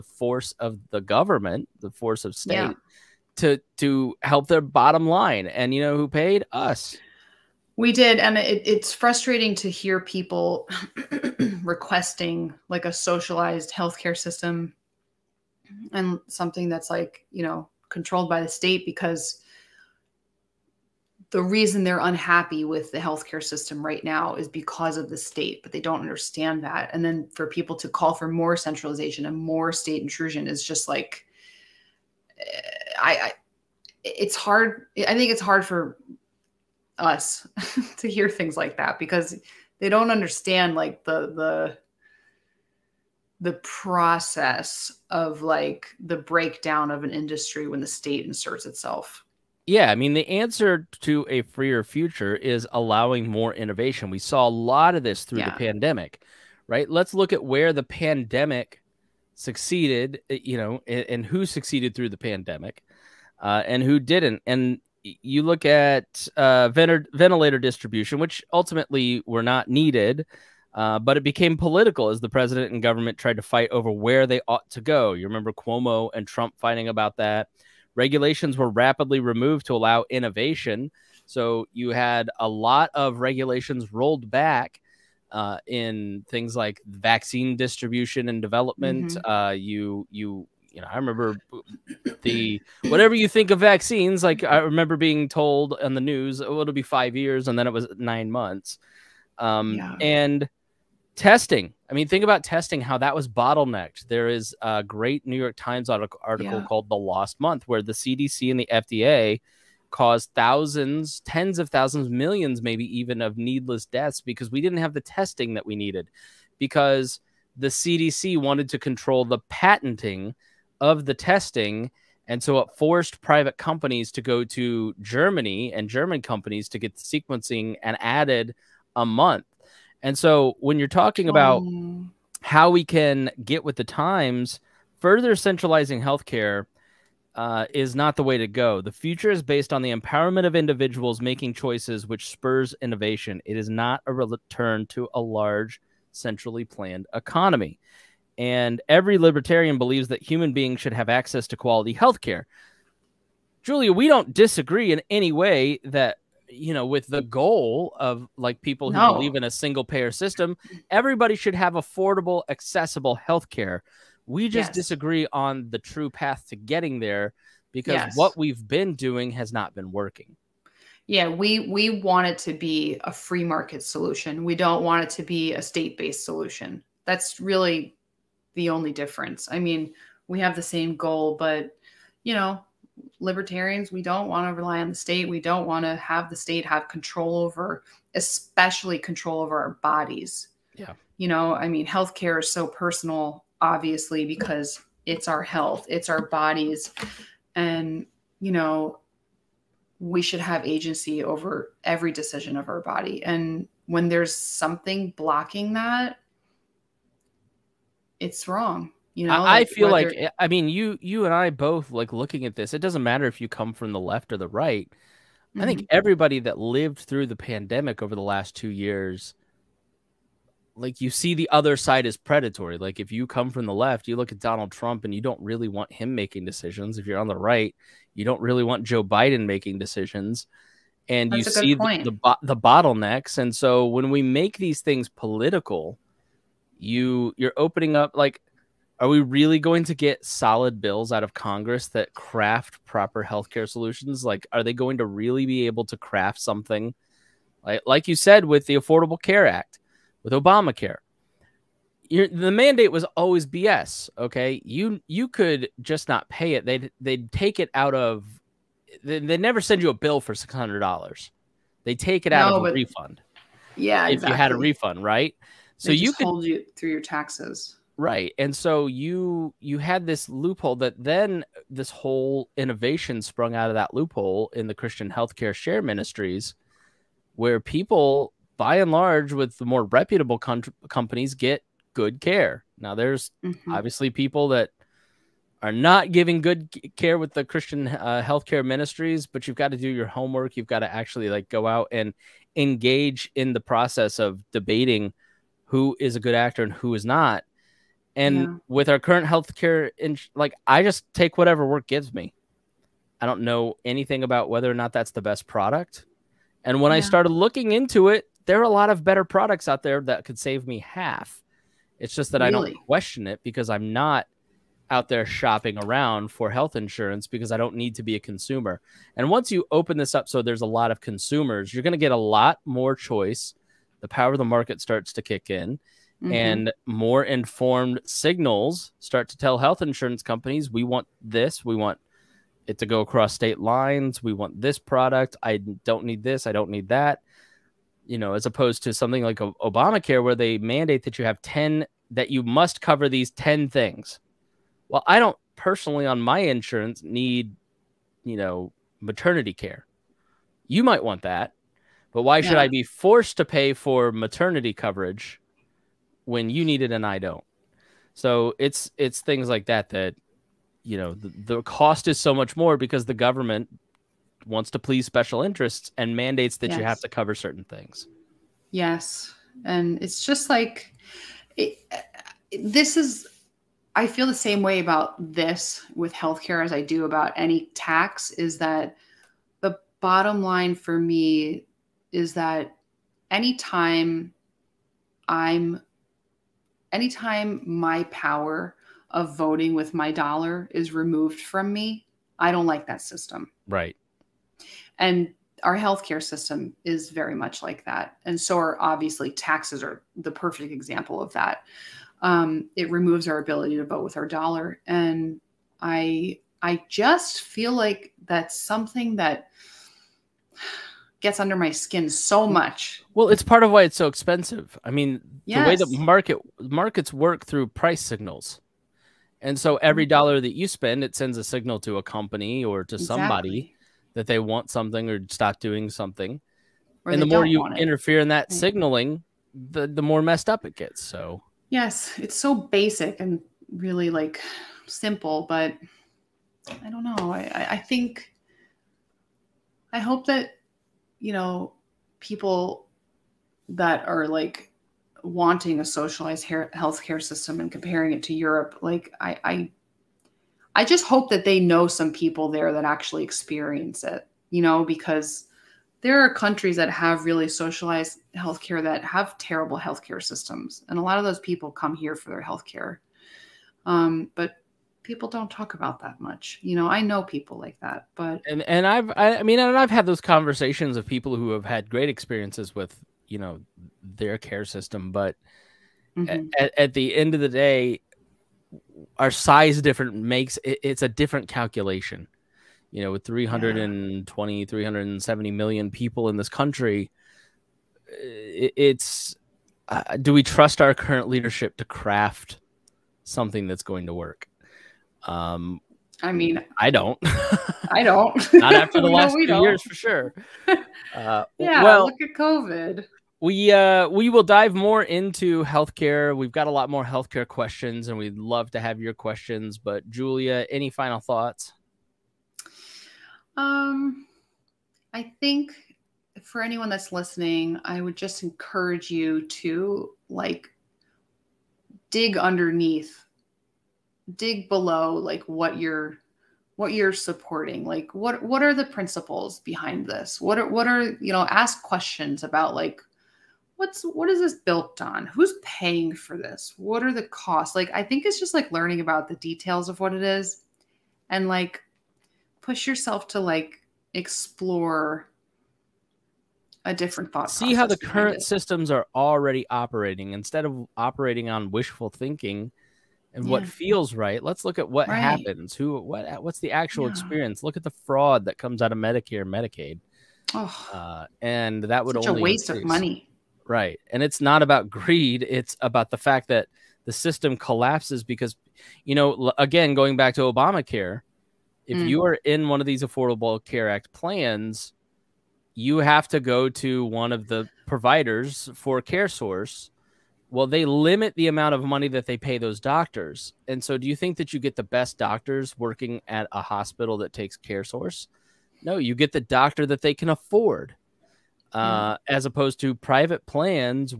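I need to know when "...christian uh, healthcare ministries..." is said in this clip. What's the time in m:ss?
4:47.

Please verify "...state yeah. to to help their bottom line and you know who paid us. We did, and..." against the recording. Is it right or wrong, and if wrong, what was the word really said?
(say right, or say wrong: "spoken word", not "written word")
right.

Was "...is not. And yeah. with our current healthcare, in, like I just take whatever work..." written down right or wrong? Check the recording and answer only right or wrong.
right.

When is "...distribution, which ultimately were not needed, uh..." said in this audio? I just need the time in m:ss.
1:07.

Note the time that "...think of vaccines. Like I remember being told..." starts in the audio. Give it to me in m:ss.
1:33.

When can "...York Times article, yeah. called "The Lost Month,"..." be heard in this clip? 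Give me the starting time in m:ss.
1:45.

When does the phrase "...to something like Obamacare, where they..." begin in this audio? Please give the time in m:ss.
5:38.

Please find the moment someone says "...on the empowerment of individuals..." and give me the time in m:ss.
2:19.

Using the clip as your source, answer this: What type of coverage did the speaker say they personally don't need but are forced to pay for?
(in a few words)
Maternity care.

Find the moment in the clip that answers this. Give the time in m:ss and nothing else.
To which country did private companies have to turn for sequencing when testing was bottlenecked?
2:04.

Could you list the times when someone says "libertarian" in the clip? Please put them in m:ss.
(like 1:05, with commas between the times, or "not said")
2:29, 3:03.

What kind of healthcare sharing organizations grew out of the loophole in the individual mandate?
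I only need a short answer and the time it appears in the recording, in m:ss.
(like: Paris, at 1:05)
Christian healthcare share ministries, at 4:34.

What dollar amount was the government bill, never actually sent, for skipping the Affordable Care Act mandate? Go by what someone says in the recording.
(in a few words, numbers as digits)
$600.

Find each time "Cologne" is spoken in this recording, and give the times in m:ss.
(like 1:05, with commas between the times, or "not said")
not said.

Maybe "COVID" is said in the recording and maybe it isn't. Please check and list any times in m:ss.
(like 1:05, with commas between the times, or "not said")
8:22.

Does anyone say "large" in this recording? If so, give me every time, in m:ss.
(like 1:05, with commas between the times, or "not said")
2:25, 4:38.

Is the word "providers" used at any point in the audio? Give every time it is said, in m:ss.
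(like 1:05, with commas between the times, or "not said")
9:37.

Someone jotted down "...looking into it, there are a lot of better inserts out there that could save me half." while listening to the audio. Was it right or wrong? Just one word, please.
wrong.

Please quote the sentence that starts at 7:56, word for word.
at, at the end of the day, our size different makes it, it's a different calculation.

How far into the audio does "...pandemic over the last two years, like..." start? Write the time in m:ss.
3:37.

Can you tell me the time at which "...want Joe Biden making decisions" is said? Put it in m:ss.
3:48.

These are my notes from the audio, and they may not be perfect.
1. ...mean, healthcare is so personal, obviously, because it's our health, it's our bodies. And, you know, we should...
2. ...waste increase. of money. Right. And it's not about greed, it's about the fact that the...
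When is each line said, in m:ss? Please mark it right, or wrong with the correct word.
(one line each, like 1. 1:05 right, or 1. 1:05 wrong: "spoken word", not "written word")
1. 3:11 right
2. 9:22 right.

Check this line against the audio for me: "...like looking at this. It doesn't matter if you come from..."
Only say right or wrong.
right.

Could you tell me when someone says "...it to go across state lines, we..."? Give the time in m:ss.
5:32.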